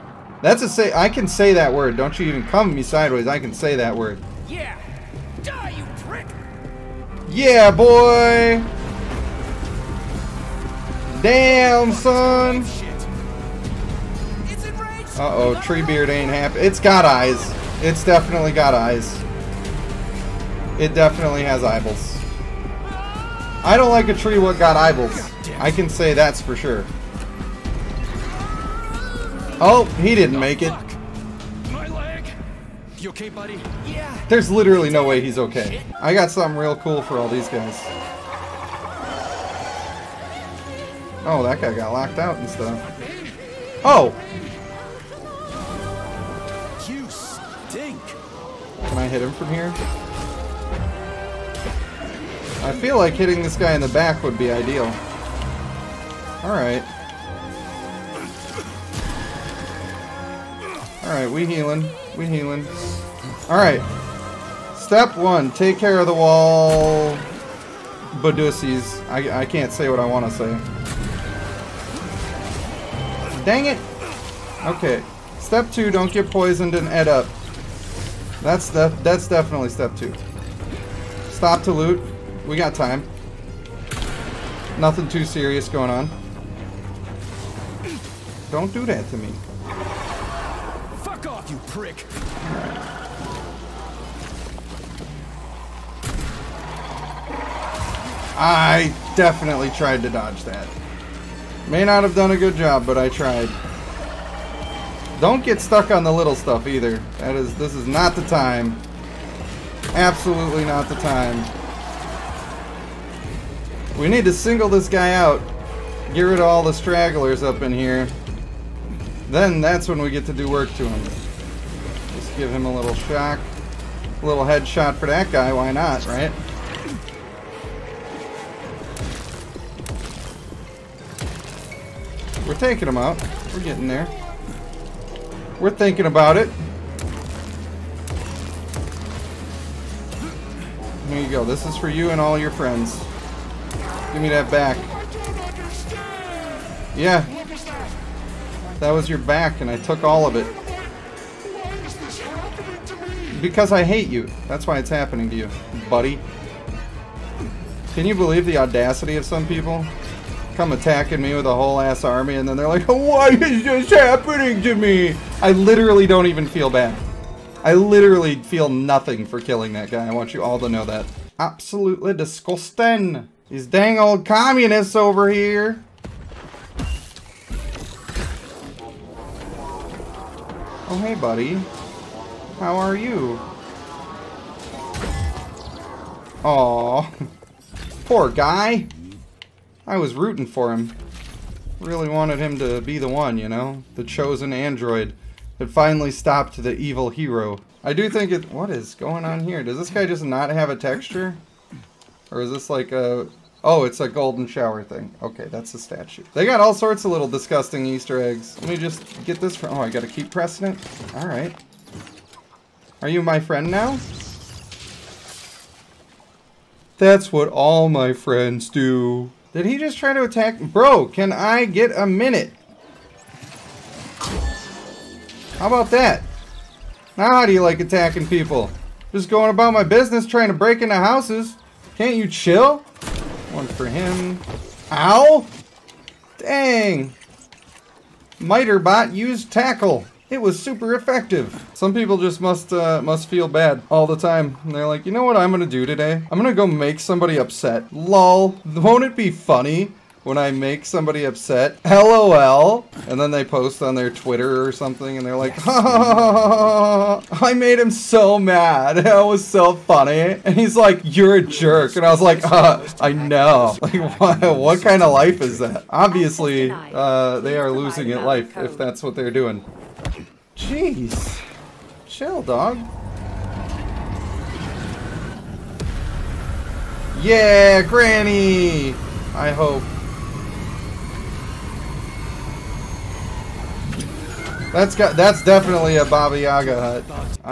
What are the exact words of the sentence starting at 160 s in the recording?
Come attacking me with a whole ass army and then they're like, why is this happening to me?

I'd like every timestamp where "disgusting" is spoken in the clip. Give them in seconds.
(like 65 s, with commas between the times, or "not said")
172 s, 207 s.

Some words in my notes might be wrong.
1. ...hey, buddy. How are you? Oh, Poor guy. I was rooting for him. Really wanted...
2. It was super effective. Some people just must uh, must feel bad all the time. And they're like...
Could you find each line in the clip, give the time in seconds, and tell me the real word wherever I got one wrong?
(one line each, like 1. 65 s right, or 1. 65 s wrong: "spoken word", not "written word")
1. 181 s right
2. 240 s right.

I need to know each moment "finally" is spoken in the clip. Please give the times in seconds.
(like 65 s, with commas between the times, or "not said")
195 s.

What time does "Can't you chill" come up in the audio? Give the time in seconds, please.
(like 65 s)
231 s.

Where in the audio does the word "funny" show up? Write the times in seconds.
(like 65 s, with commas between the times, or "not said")
249 s, 259 s.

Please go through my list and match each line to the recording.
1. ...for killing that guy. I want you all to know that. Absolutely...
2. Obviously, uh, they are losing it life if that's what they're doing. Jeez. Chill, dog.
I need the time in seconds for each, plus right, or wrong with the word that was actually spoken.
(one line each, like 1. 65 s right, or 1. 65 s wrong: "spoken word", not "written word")
1. 169 s right
2. 265 s right.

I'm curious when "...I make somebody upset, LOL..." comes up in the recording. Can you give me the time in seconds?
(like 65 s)
250 s.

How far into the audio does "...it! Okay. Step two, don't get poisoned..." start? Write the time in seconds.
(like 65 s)
73 s.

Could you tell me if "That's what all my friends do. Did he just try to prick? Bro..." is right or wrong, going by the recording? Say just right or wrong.
wrong.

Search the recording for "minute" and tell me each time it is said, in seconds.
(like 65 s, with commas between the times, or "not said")
222 s.